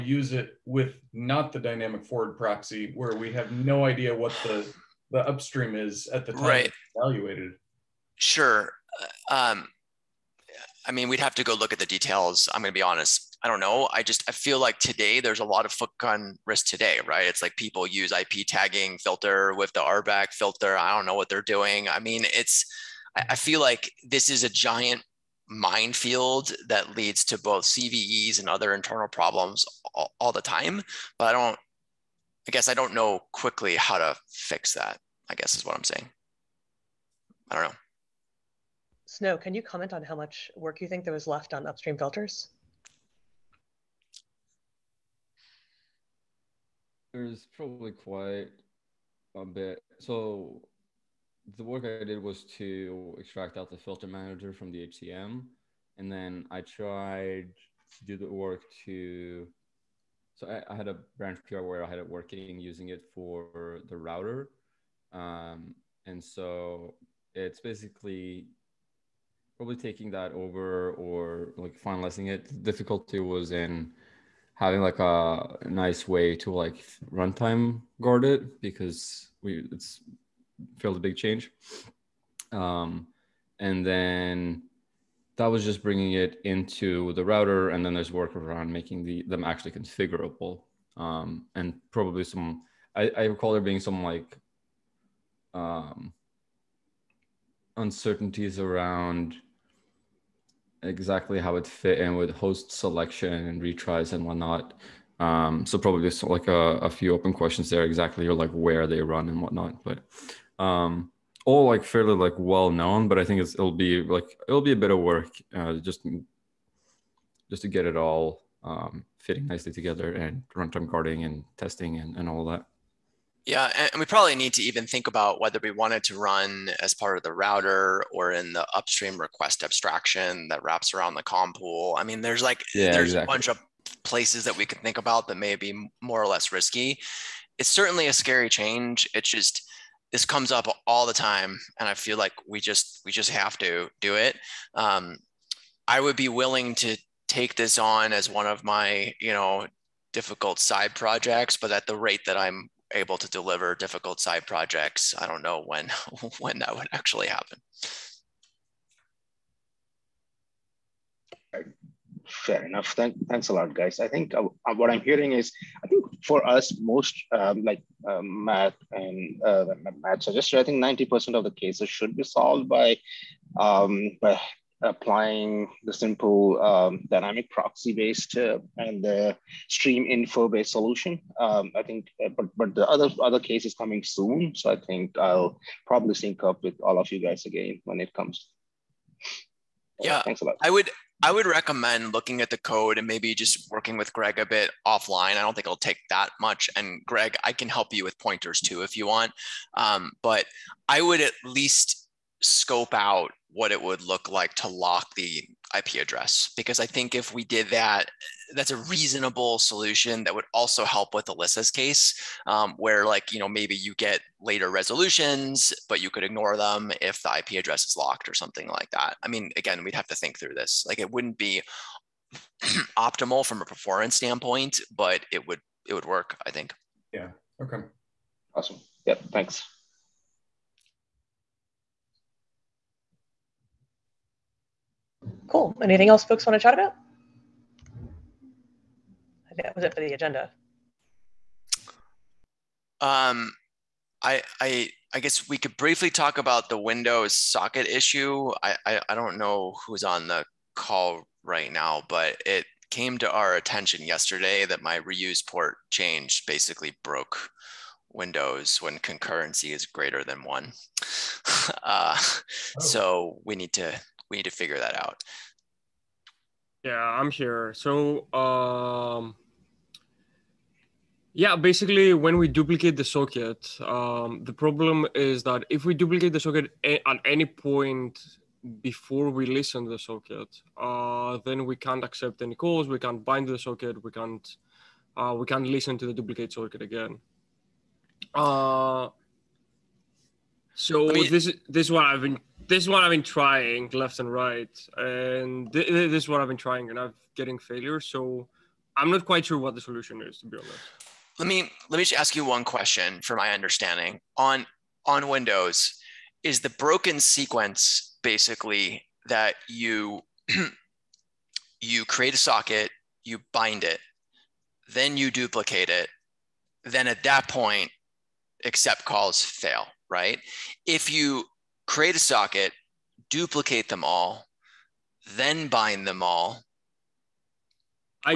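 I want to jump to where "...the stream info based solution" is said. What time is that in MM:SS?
02:59.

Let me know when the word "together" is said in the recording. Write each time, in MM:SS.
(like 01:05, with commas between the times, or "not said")
01:59.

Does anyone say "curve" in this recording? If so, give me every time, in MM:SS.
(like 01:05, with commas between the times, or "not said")
not said.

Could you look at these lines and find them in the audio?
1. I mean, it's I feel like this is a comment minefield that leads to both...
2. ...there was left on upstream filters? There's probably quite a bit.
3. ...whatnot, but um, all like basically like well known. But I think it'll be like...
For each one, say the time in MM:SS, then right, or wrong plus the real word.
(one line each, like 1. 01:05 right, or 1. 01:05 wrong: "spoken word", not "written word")
1. 00:21 wrong: "giant", not "comment"
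2. 00:41 right
3. 01:49 wrong: "fairly", not "basically".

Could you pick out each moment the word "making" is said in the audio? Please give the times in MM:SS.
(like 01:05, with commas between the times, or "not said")
01:28.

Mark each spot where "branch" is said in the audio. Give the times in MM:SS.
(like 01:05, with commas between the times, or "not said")
01:01.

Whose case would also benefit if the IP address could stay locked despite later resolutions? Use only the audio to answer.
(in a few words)
Alyssa.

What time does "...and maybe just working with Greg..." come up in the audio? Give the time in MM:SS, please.
03:12.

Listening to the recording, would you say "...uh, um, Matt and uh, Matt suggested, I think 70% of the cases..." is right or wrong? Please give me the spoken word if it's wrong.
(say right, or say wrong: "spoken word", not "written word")
wrong: "90", not "70".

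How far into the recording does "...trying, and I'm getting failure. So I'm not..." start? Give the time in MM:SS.
04:56.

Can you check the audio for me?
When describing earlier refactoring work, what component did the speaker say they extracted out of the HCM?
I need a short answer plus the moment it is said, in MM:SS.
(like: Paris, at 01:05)
filter manager, at 00:53.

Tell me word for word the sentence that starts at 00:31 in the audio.
But I don't I guess I don't know quickly how to fix that, I guess is what I'm saying.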